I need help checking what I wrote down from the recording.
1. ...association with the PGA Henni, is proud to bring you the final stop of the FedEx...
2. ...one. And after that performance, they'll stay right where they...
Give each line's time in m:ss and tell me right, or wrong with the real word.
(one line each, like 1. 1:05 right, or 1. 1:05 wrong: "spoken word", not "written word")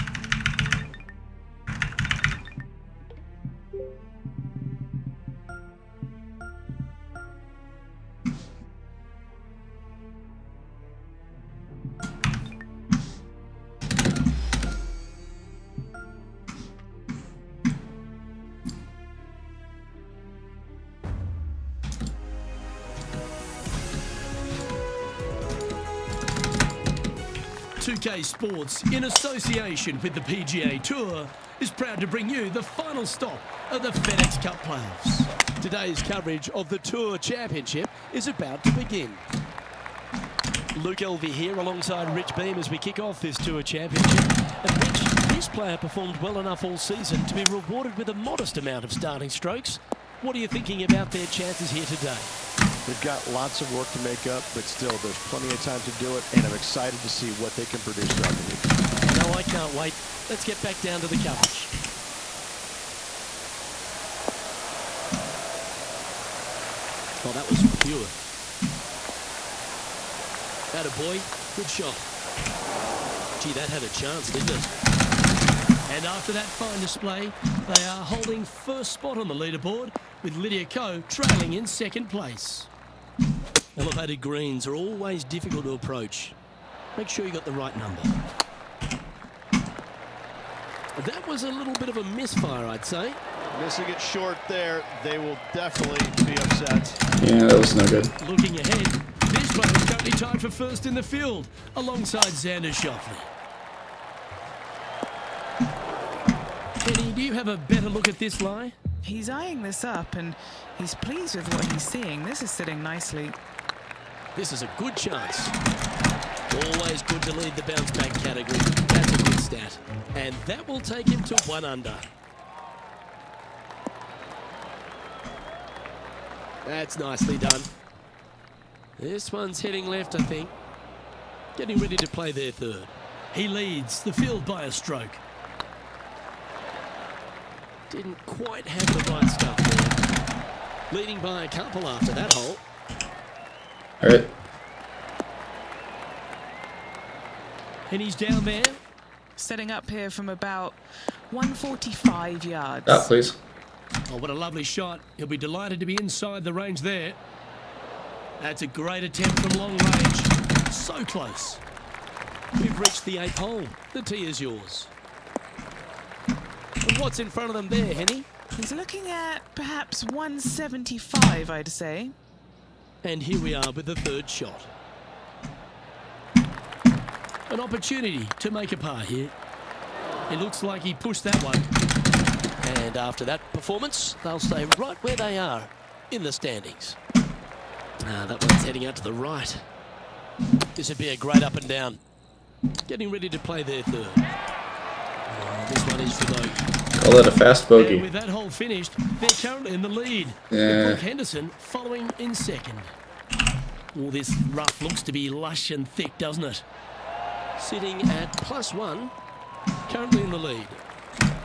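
1. 0:29 wrong: "Tour", not "Henni"
2. 3:01 right.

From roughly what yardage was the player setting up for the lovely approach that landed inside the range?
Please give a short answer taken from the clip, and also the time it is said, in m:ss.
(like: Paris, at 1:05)
145 yards, at 2:31.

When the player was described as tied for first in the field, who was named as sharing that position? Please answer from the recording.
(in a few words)
Xander Schauffele.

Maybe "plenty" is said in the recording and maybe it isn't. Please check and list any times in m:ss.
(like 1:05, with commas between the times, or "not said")
0:55.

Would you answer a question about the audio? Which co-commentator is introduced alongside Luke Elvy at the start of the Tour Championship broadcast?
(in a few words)
Rich Beem.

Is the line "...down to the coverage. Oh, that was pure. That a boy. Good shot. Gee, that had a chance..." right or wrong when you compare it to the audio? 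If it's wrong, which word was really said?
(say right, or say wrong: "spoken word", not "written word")
right.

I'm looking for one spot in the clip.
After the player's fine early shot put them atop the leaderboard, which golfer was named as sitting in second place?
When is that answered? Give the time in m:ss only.
1:20.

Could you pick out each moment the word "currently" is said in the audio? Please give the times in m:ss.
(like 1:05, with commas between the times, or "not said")
1:39, 3:19, 3:29.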